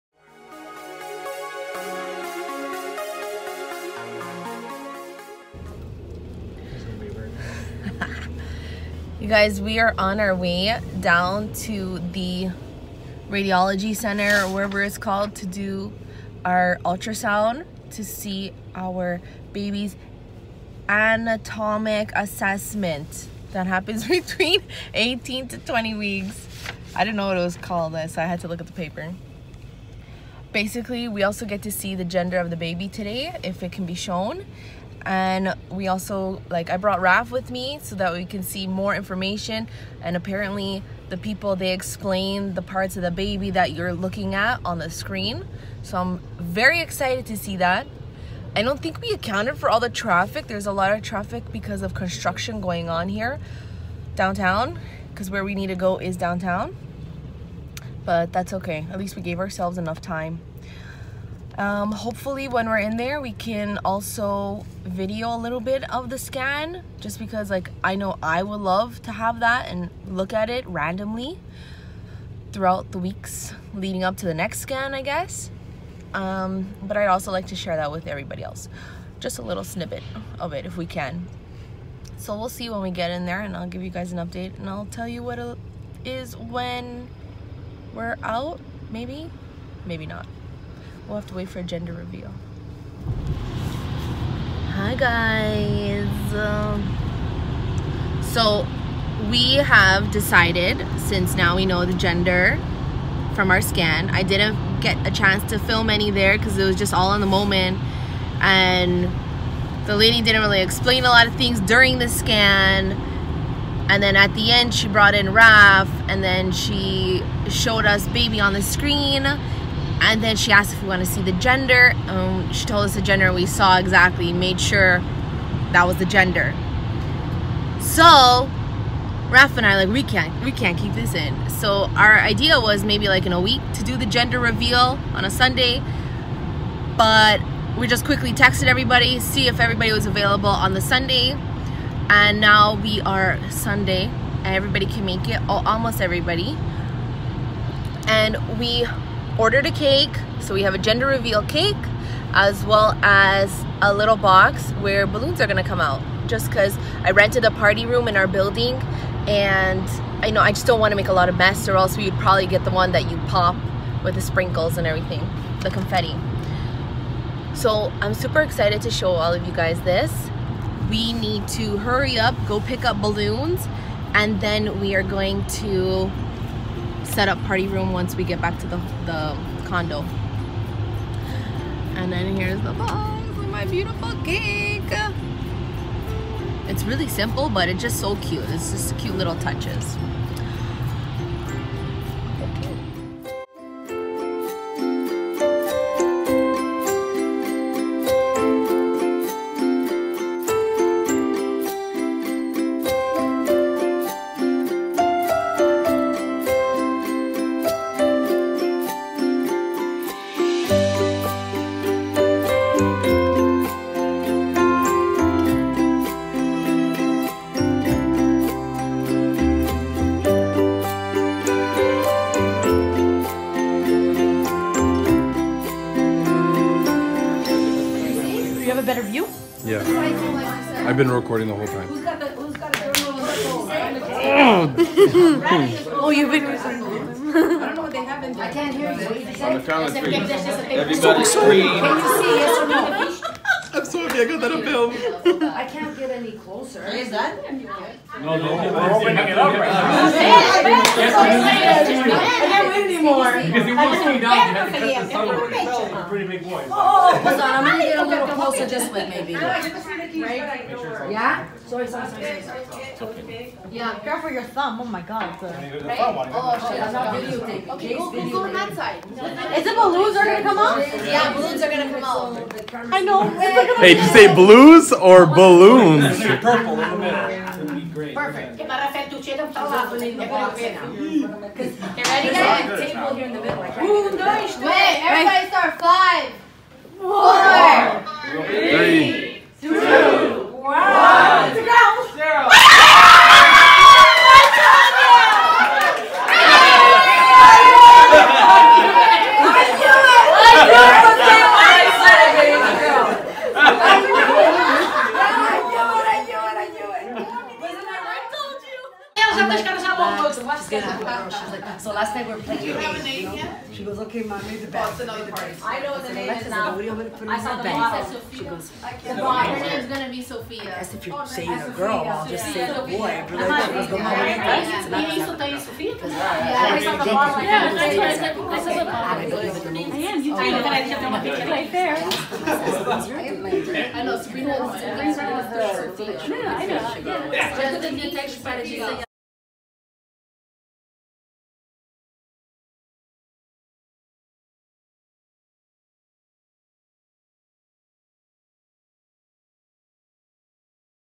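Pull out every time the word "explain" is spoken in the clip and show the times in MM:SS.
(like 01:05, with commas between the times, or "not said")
00:41, 01:50.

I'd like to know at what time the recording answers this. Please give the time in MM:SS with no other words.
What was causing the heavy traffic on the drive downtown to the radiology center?
00:51.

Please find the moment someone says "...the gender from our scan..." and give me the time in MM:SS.
01:41.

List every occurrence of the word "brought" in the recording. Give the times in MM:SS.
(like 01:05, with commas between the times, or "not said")
00:36, 01:54.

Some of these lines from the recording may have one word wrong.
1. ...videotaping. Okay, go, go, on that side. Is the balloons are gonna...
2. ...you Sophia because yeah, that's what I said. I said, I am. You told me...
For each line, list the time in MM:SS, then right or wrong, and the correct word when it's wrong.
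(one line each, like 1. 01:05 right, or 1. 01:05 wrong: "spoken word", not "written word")
1. 04:27 right
2. 05:25 right.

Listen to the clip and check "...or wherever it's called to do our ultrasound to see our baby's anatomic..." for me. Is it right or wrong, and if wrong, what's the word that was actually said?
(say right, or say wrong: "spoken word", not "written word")
right.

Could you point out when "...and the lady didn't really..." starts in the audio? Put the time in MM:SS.
01:48.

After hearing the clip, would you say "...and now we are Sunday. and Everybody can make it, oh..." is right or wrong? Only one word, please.
right.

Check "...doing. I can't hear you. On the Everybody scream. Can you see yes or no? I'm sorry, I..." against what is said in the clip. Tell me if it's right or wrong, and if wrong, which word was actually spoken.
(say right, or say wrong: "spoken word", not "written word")
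right.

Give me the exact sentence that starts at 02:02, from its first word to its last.
Um, she told us the gender, we saw exactly, made sure that was the gender.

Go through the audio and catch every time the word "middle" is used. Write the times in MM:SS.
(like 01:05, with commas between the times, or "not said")
04:36, 04:43.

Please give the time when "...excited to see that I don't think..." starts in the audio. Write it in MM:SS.
00:46.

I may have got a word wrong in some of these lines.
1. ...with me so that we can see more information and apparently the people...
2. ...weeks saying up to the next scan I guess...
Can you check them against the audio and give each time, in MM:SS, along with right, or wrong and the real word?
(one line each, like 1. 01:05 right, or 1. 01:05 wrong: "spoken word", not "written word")
1. 00:37 right
2. 01:12 wrong: "leading", not "saying".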